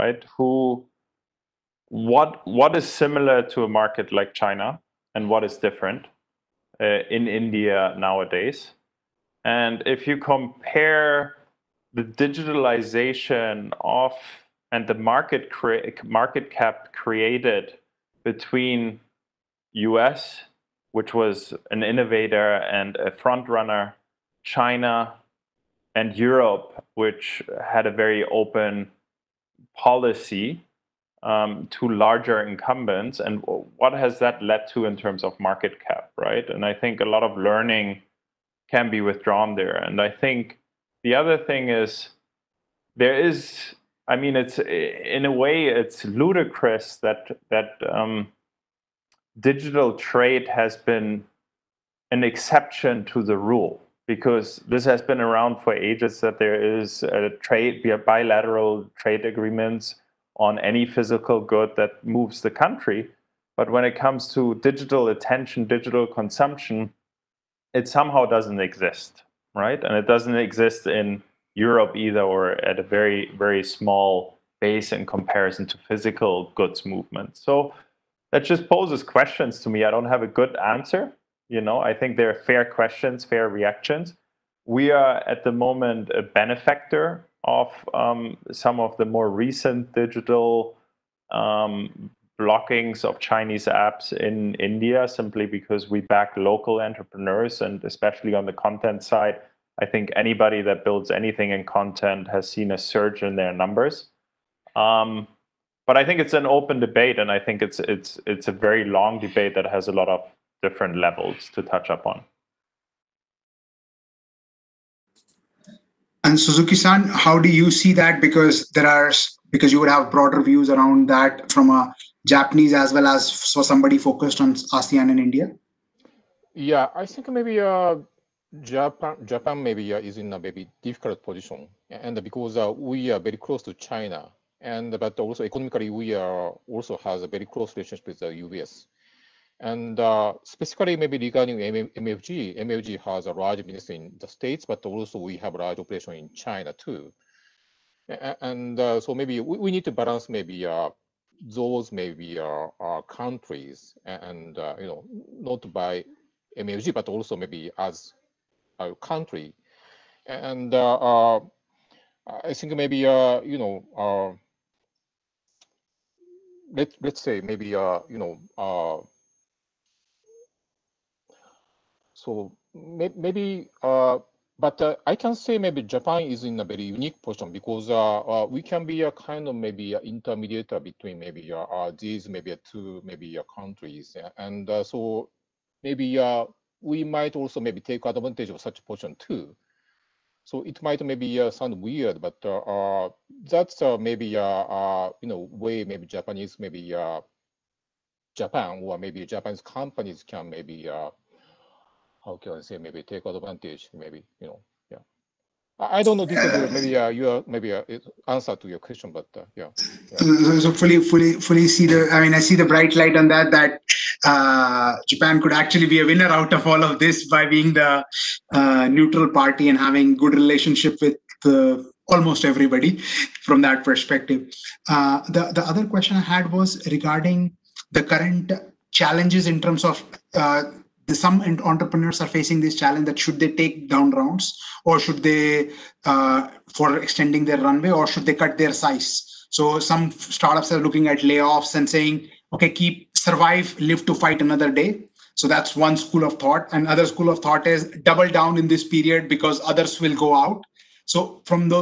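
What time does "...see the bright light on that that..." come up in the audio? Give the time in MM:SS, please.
03:32.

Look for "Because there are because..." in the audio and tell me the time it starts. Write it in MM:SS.
01:58.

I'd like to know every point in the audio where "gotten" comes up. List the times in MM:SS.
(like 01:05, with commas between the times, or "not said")
not said.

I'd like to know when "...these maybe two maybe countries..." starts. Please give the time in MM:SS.
03:01.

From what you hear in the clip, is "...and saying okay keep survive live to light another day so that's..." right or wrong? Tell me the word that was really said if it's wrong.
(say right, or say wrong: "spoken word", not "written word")
wrong: "fight", not "light".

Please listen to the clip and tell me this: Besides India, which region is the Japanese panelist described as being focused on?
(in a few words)
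ASEAN.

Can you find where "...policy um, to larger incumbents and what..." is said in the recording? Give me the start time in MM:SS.
00:29.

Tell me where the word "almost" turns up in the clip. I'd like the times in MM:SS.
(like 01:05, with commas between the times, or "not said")
03:42.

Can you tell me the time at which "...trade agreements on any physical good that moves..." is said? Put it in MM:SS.
00:58.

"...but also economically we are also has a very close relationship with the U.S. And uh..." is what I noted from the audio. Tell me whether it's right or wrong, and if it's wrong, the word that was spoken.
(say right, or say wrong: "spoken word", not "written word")
right.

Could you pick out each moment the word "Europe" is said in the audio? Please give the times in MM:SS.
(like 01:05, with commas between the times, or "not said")
00:26, 01:11.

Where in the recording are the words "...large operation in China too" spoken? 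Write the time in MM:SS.
02:25.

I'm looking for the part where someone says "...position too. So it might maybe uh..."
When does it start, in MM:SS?
03:08.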